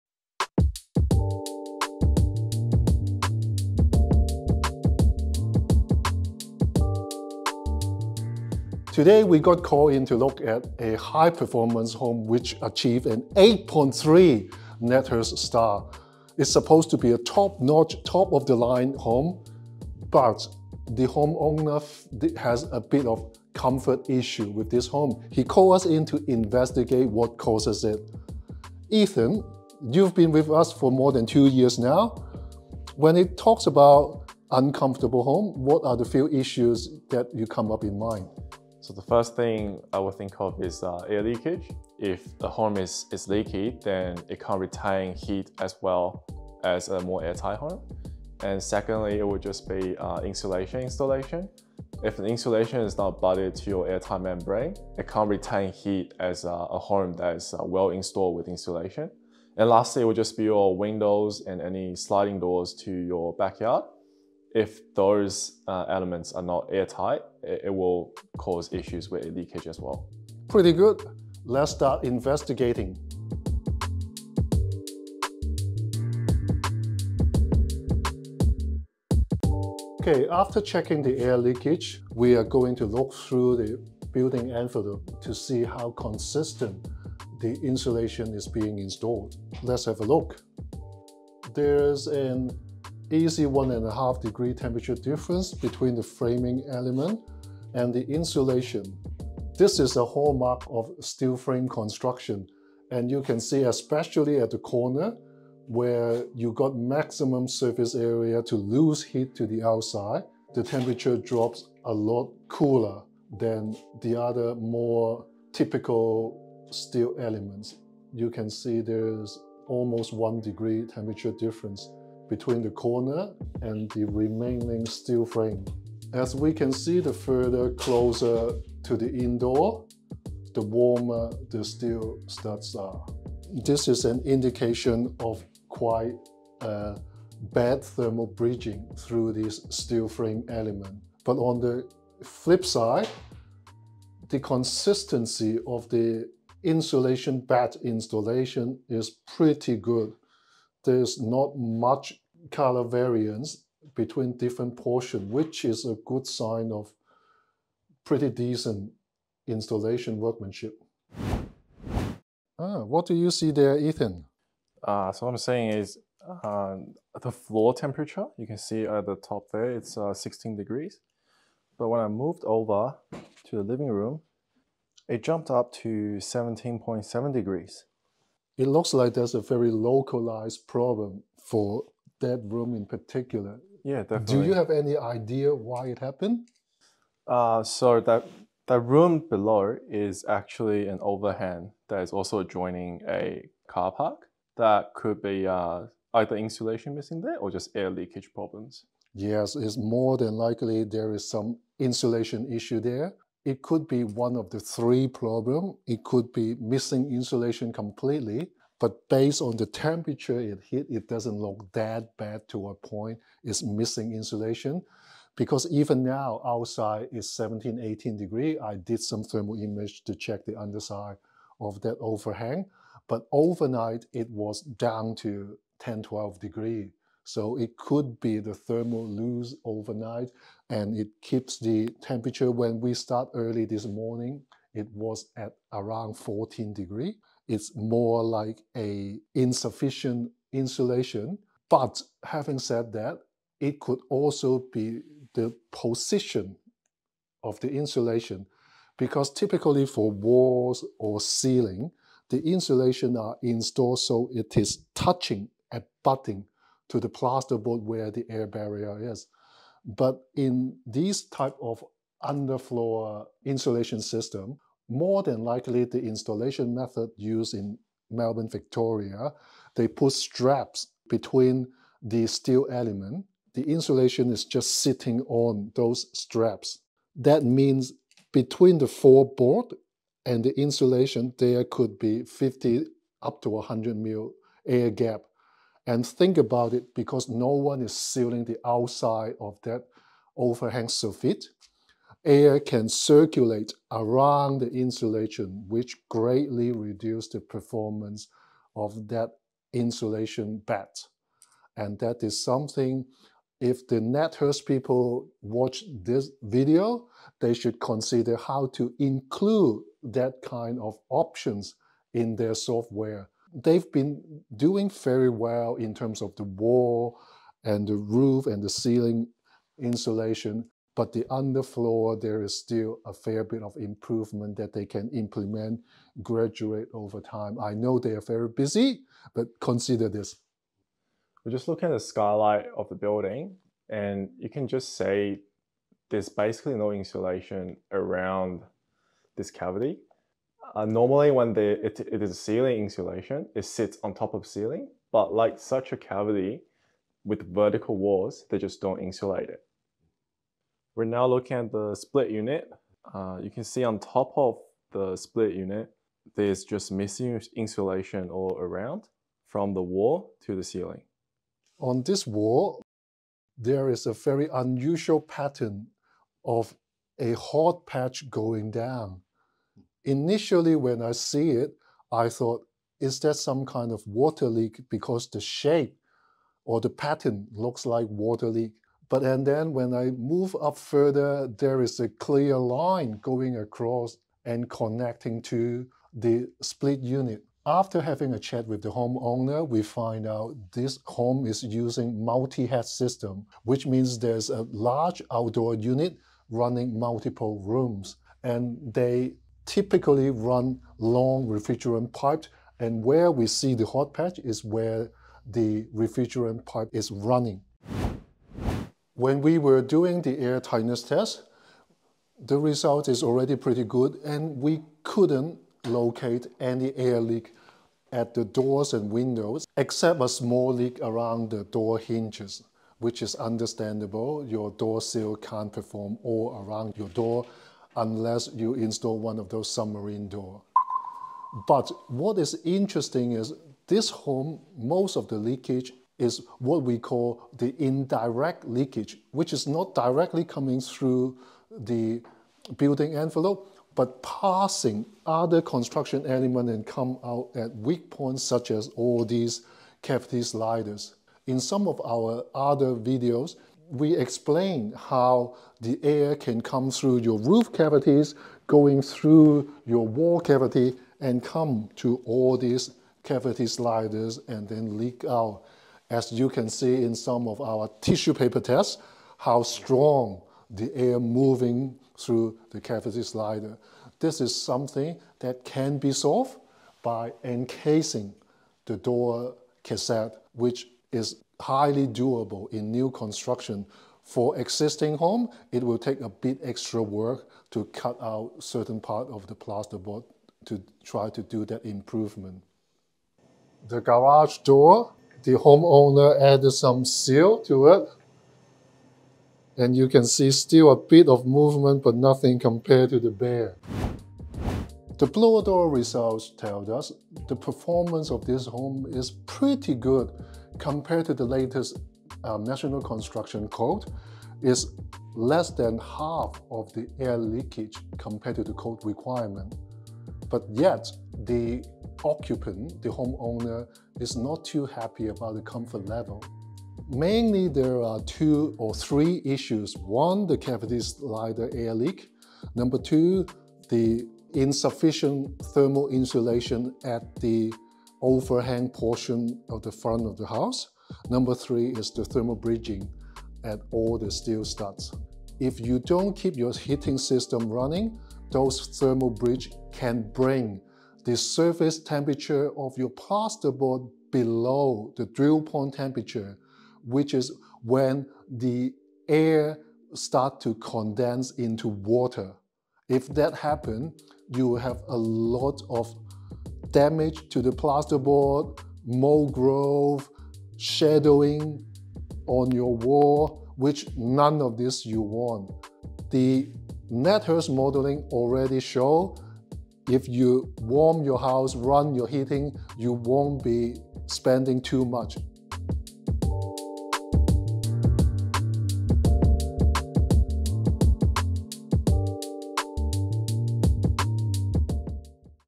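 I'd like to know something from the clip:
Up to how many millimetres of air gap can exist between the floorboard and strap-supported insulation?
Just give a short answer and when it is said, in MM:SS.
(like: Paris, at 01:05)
100, at 04:43.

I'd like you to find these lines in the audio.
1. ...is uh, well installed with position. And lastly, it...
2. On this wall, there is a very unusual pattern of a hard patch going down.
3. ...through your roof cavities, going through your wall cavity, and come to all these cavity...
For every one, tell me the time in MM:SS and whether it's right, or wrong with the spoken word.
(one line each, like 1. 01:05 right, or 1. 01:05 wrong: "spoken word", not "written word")
1. 00:57 wrong: "insulation", not "position"
2. 06:01 right
3. 07:36 right.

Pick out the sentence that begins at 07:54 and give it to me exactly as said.
This is something that can be solved by encasing the door cassette, which is highly doable in new construction.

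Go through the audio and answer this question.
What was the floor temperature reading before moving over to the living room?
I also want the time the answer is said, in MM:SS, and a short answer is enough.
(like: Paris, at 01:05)
16 degrees, at 02:50.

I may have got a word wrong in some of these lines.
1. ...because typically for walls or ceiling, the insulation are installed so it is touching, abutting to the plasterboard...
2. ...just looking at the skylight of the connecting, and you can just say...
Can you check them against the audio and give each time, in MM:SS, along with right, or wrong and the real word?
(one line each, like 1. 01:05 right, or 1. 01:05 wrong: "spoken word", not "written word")
1. 04:08 right
2. 05:31 wrong: "building", not "connecting".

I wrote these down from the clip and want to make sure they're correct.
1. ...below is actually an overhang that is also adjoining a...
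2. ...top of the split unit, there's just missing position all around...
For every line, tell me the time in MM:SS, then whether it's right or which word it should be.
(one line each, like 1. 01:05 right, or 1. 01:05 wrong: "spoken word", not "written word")
1. 03:09 right
2. 05:53 wrong: "insulation", not "position".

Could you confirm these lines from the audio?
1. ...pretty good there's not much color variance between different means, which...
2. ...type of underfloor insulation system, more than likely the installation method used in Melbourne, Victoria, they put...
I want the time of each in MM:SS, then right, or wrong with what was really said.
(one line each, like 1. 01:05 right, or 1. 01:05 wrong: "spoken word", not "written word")
1. 02:29 wrong: "portions", not "means"
2. 04:21 right.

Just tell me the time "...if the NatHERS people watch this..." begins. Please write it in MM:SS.
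05:03.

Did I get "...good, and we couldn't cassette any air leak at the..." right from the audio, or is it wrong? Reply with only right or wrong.
wrong.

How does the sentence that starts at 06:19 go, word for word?
But and then when I move up further, there is a clear line going across and connecting to the split unit.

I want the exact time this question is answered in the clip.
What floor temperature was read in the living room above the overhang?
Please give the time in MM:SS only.
02:56.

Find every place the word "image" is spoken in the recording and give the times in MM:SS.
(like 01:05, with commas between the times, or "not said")
03:39.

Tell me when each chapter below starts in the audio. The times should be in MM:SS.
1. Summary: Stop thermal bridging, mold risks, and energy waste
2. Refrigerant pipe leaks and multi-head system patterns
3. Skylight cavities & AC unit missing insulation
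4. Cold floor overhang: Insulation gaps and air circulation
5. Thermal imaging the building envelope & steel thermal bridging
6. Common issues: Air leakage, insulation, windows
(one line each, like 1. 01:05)
1. 07:00
2. 06:00
3. 05:36
4. 04:15
5. 01:53
6. 00:30.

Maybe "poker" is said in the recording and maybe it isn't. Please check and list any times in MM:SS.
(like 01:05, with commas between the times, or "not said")
not said.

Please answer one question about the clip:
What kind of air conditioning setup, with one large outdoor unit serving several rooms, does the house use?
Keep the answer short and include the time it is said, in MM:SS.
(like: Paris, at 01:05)
multi-head system, at 06:32.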